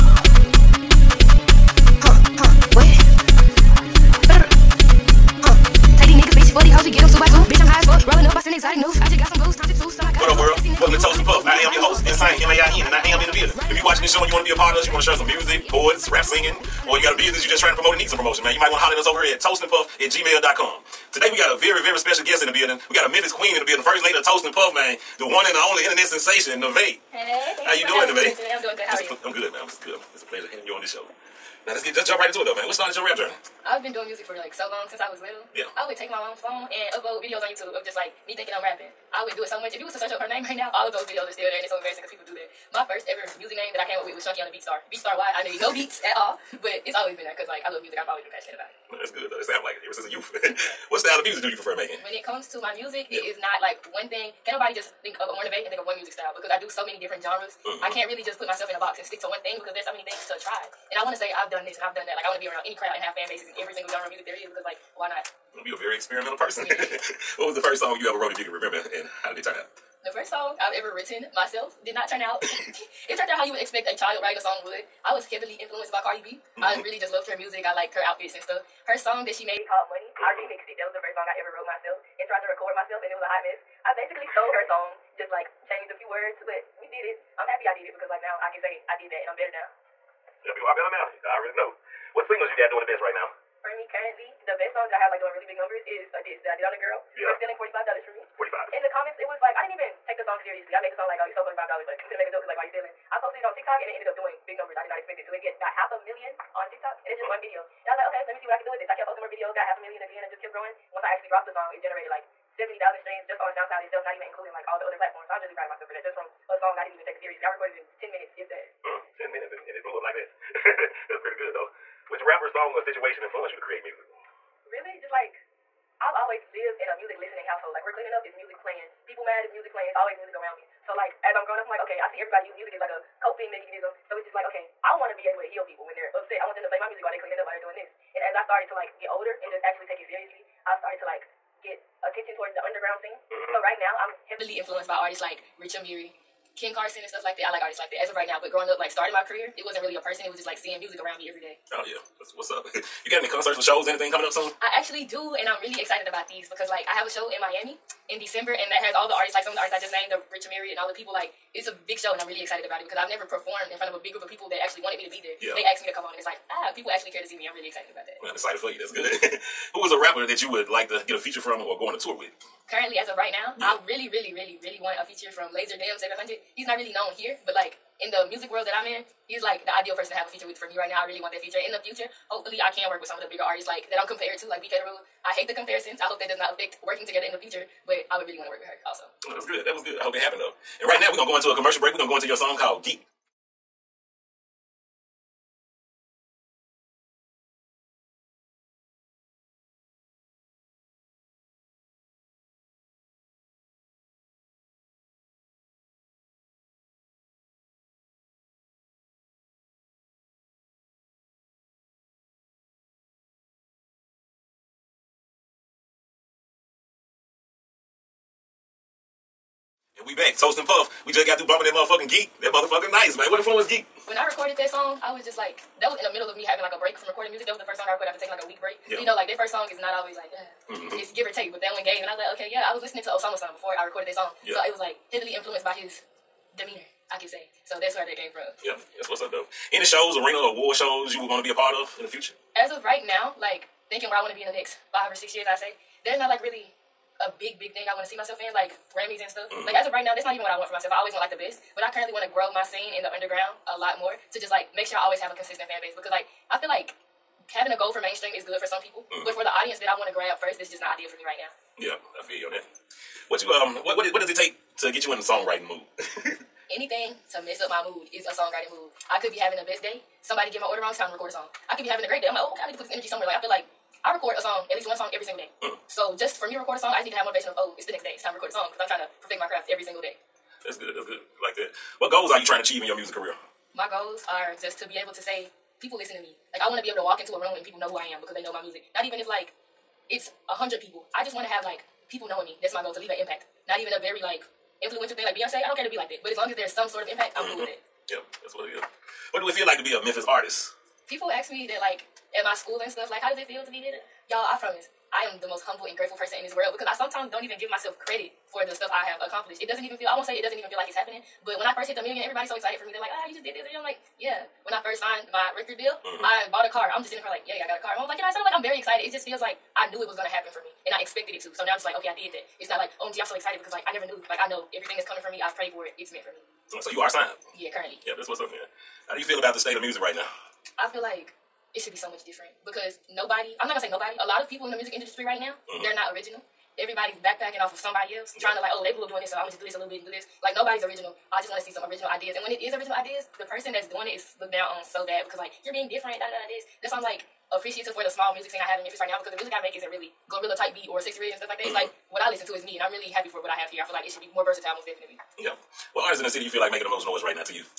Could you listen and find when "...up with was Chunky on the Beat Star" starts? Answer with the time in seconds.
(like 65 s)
43 s.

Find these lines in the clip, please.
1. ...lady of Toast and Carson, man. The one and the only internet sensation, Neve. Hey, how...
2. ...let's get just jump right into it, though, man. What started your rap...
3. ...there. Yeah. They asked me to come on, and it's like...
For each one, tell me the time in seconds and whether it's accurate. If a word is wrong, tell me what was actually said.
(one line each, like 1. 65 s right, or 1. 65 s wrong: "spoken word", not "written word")
1. 24 s wrong: "Puff", not "Carson"
2. 31 s right
3. 165 s right.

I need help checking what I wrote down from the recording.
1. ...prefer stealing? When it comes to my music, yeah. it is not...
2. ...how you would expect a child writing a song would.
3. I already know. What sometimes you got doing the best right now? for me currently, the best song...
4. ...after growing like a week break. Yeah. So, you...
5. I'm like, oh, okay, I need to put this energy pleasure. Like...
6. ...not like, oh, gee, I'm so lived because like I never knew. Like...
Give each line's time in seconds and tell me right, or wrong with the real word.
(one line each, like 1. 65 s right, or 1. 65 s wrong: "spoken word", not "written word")
1. 51 s wrong: "making", not "stealing"
2. 73 s right
3. 91 s wrong: "singles", not "sometimes"
4. 228 s wrong: "taking", not "growing"
5. 272 s wrong: "somewhere", not "pleasure"
6. 322 s wrong: "excited", not "lived".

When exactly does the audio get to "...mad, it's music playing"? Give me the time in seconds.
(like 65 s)
129 s.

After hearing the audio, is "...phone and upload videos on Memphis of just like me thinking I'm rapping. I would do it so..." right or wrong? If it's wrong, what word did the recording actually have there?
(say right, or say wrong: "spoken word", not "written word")
wrong: "YouTube", not "Memphis".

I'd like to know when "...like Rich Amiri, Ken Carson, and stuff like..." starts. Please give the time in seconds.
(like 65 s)
145 s.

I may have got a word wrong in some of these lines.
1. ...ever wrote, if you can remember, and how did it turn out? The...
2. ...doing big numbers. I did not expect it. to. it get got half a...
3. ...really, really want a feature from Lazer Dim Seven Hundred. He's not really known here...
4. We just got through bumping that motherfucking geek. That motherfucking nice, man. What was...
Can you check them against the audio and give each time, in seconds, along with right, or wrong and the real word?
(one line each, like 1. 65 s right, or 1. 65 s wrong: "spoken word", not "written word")
1. 68 s right
2. 104 s right
3. 174 s right
4. 221 s right.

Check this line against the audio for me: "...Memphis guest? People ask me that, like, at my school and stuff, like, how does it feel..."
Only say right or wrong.
wrong.